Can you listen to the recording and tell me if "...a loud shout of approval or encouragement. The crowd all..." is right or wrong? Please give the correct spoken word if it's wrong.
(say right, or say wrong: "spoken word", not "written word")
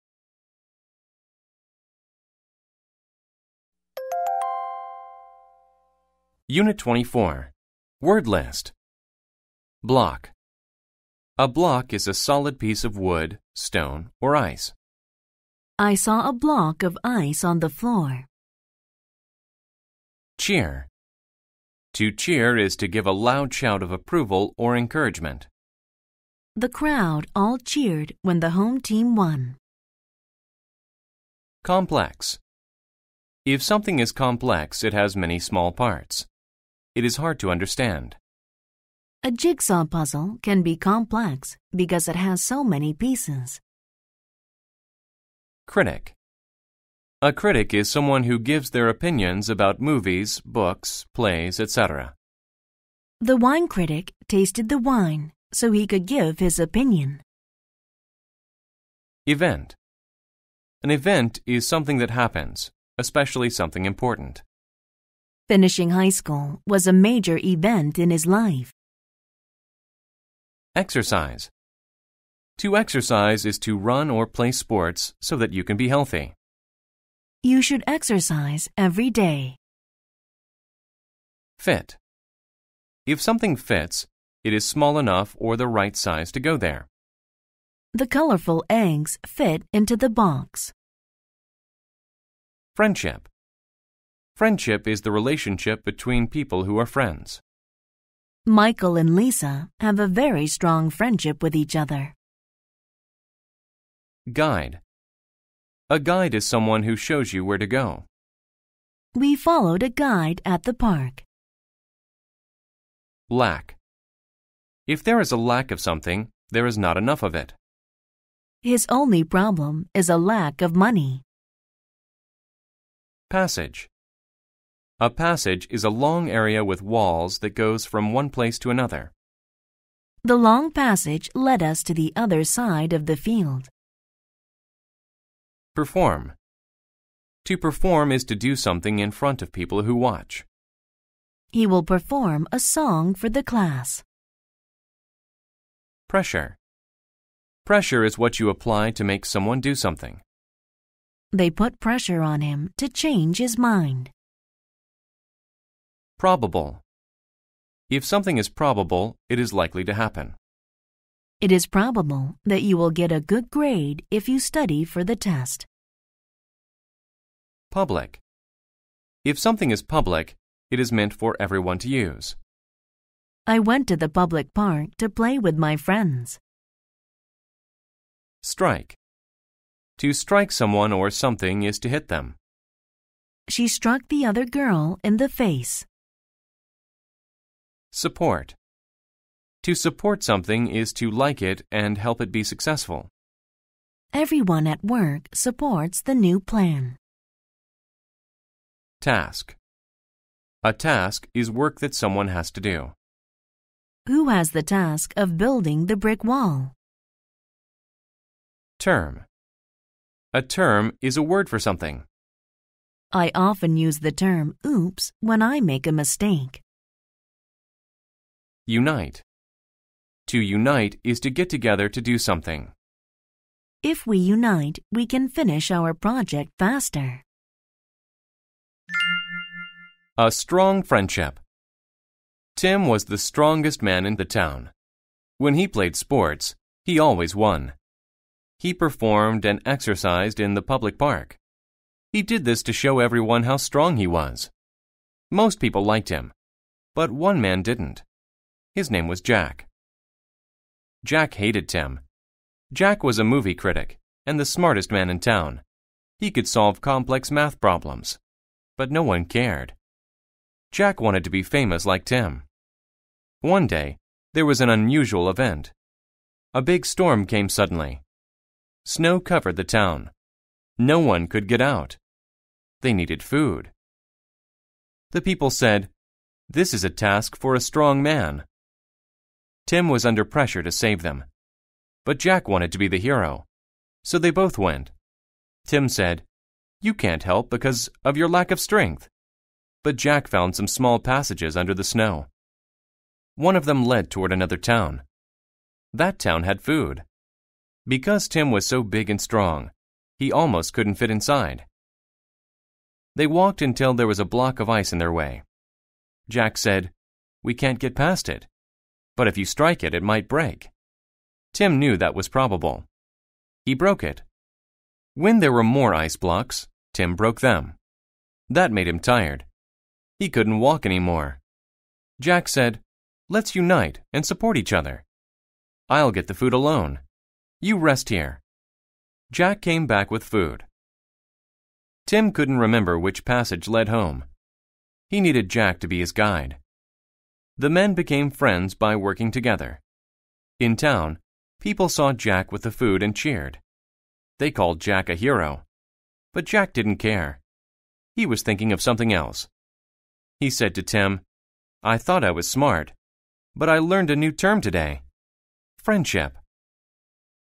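right.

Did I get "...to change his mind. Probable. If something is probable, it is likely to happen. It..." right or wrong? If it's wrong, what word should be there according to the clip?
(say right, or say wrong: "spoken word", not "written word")
right.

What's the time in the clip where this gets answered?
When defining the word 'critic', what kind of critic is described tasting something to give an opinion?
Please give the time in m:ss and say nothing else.
0:53.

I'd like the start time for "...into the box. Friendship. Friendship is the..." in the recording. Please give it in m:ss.
1:29.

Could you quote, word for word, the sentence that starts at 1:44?
Guide A guide is someone who shows you where to go.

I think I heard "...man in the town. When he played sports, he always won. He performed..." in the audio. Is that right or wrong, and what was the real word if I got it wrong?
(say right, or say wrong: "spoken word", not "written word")
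right.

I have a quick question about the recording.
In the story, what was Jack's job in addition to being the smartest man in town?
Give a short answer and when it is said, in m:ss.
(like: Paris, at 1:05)
Movie critic, at 4:13.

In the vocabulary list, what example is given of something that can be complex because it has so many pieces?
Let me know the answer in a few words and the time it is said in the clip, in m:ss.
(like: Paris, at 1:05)
A jigsaw puzzle, at 0:39.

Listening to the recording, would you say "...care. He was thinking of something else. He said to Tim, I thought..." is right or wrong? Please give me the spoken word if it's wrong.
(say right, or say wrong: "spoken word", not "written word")
right.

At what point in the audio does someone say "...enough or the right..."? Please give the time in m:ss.
1:24.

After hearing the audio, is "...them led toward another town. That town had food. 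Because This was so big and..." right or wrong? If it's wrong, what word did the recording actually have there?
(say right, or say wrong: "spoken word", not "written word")
wrong: "Tim", not "This".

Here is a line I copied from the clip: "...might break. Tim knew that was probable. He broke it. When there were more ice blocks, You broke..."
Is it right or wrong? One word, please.
wrong.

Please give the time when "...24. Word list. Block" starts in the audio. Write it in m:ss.
0:06.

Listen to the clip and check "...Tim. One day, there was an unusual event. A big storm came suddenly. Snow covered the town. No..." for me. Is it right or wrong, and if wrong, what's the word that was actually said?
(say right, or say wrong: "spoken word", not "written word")
right.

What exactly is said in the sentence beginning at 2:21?
He will perform a song for the class.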